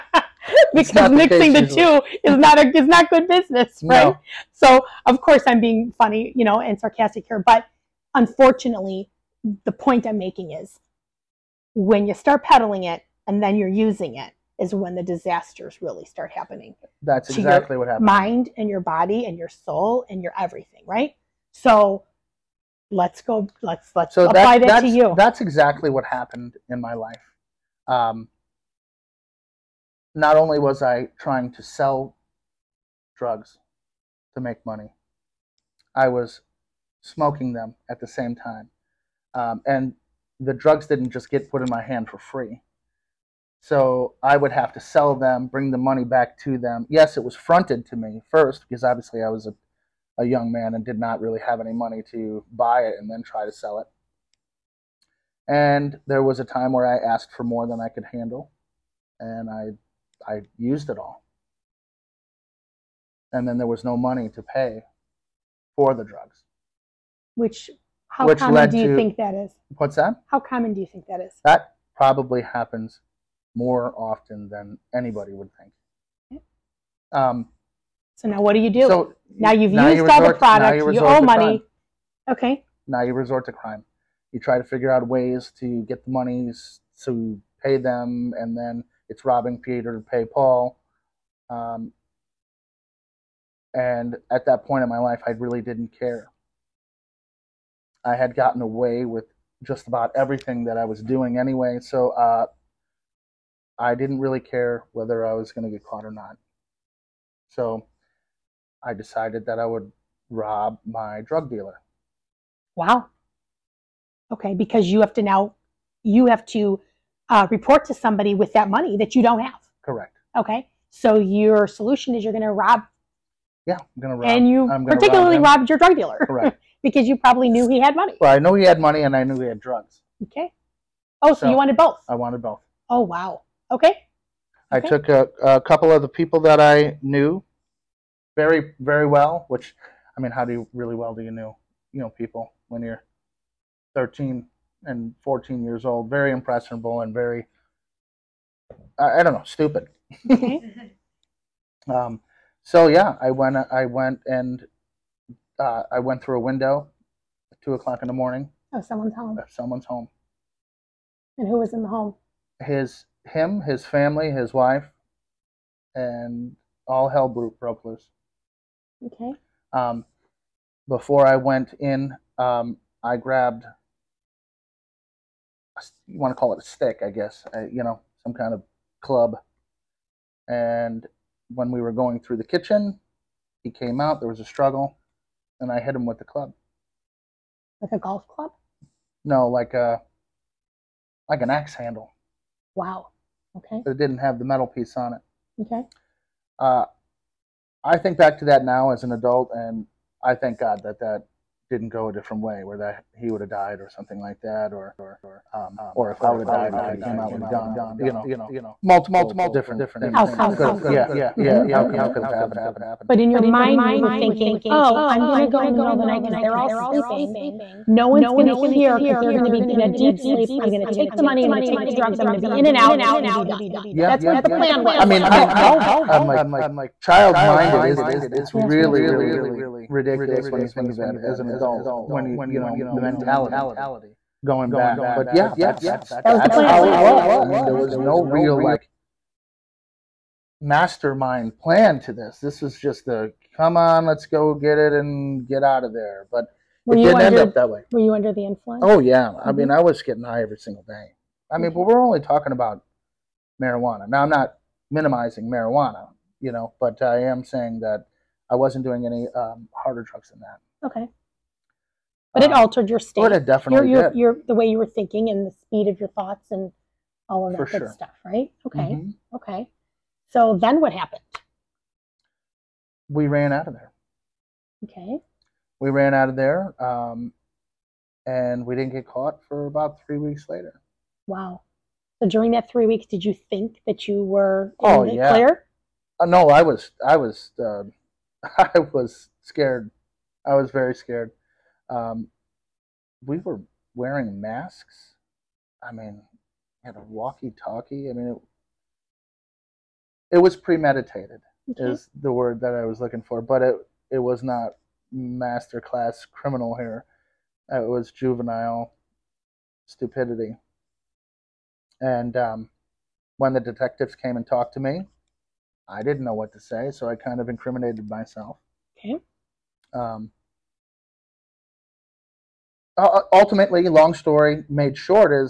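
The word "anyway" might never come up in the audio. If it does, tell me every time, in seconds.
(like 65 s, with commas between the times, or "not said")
101 s.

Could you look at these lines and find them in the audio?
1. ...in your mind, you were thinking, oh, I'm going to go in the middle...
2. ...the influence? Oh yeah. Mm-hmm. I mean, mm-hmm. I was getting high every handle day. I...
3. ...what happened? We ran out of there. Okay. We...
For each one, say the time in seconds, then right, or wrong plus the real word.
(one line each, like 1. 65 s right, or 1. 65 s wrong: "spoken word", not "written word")
1. 213 s right
2. 248 s wrong: "single", not "handle"
3. 270 s right.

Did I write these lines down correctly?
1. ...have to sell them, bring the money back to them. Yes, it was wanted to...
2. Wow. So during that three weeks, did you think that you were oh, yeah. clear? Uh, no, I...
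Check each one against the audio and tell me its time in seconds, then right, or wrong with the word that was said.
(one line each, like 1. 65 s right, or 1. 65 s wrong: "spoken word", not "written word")
1. 44 s wrong: "fronted", not "wanted"
2. 281 s right.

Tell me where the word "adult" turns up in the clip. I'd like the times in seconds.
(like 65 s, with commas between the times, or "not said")
199 s, 231 s.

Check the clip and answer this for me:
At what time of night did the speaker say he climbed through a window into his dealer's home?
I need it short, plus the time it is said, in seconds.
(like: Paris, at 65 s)
2 o'clock in the morning, at 157 s.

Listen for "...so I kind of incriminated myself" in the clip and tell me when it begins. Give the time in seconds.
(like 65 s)
316 s.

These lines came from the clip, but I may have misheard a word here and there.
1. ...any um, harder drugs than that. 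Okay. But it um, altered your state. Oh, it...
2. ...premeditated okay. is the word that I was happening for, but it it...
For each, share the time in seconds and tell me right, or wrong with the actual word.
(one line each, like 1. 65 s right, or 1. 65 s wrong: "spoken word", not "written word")
1. 259 s right
2. 300 s wrong: "looking", not "happening".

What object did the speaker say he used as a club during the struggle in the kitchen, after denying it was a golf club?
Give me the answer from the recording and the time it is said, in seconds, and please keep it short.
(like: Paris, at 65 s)
Axe handle, at 191 s.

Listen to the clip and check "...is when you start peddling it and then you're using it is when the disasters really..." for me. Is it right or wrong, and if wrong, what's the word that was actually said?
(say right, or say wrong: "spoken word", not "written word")
right.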